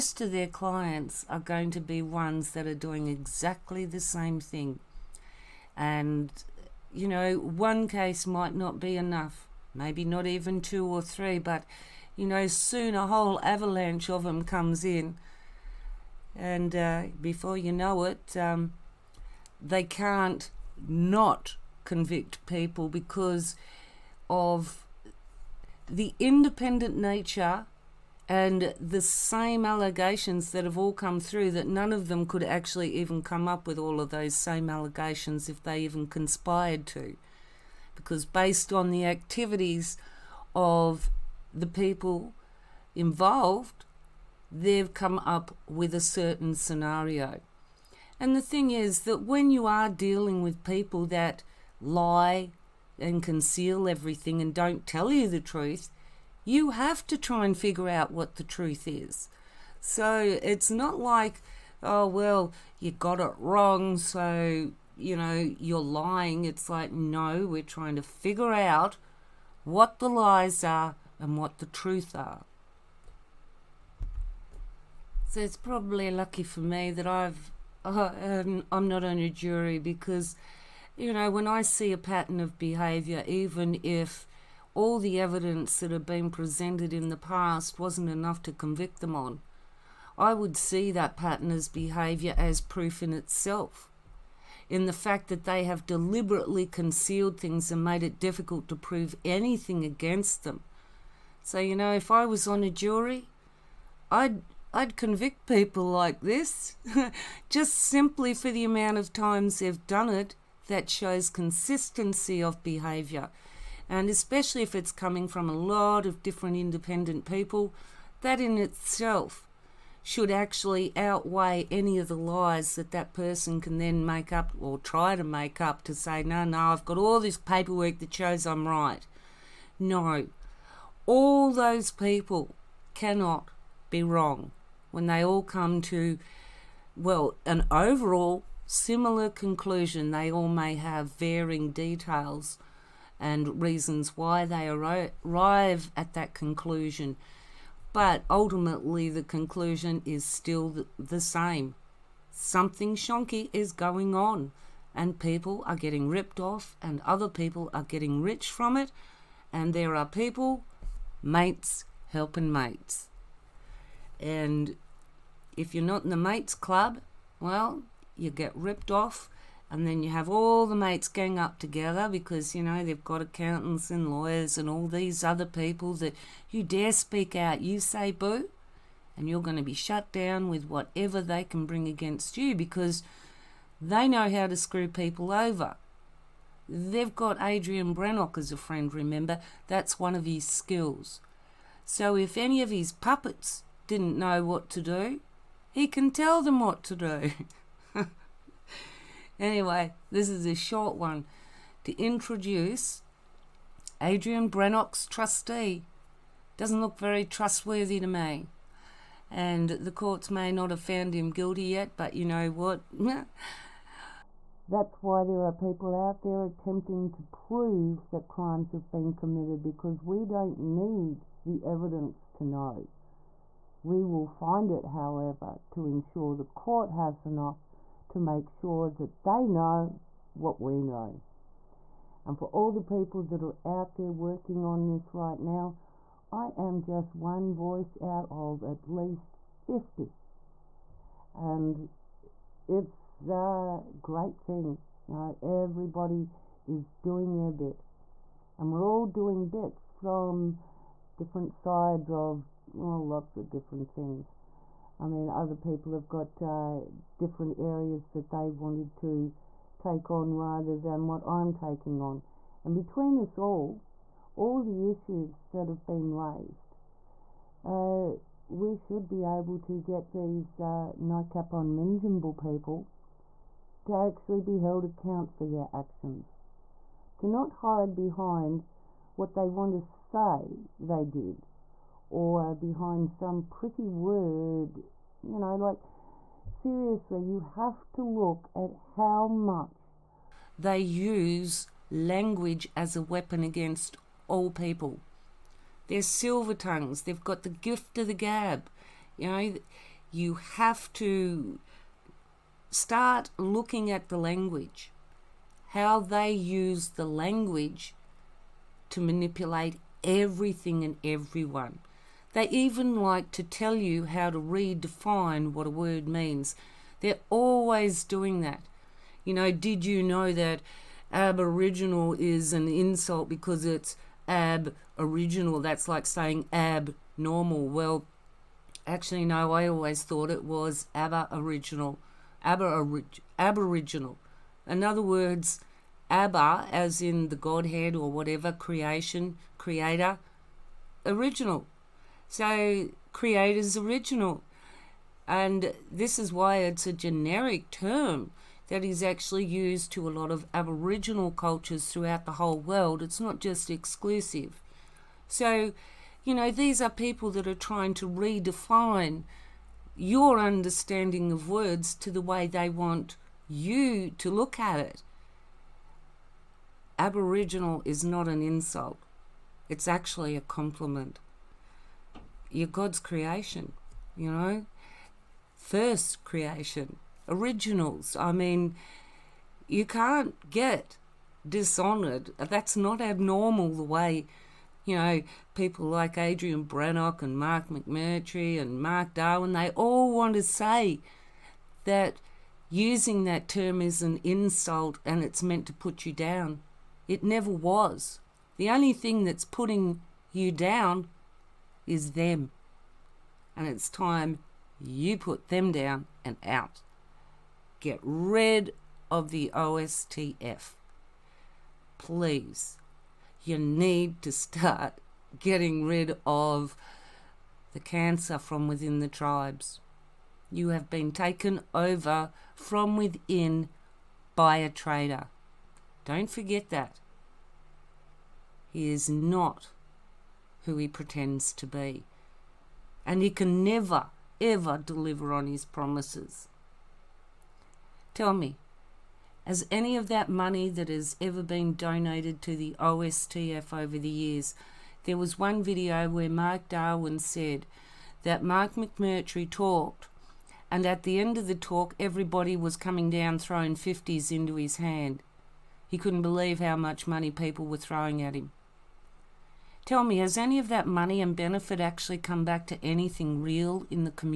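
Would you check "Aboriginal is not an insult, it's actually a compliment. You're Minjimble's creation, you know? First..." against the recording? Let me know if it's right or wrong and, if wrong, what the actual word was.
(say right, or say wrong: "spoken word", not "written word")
wrong: "God", not "Minjimble".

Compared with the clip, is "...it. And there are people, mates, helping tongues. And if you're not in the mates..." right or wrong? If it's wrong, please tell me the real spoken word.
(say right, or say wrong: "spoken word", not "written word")
wrong: "mates", not "tongues".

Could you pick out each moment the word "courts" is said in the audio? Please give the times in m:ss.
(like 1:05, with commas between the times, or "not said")
3:29, 3:46.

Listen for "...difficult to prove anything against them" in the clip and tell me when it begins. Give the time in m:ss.
1:38.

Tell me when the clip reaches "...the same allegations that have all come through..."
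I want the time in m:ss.
0:28.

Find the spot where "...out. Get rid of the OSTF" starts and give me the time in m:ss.
6:46.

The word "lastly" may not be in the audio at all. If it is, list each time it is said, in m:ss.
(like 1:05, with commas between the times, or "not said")
not said.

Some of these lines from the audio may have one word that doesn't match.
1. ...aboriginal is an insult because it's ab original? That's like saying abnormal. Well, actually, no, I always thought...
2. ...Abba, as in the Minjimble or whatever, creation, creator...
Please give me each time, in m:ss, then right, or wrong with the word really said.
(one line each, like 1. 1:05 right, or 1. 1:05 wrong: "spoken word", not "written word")
1. 5:21 right
2. 5:36 wrong: "Godhead", not "Minjimble".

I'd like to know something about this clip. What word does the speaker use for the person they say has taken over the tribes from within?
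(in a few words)
trader.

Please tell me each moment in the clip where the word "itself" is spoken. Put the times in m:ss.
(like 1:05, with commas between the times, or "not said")
1:33, 1:58.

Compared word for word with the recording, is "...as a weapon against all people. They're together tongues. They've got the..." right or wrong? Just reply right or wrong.
wrong.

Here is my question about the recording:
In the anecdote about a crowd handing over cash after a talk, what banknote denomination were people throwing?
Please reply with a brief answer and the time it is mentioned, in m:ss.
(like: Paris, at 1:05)
50s, at 7:33.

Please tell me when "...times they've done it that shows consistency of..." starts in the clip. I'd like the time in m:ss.
1:49.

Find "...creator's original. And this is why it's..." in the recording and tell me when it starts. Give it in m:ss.
5:43.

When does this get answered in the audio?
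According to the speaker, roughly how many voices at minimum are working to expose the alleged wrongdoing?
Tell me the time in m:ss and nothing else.
3:58.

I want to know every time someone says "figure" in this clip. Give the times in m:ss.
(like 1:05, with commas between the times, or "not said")
0:57, 1:08.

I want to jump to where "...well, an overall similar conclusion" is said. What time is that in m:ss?
2:16.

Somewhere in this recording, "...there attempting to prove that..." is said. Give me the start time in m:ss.
3:36.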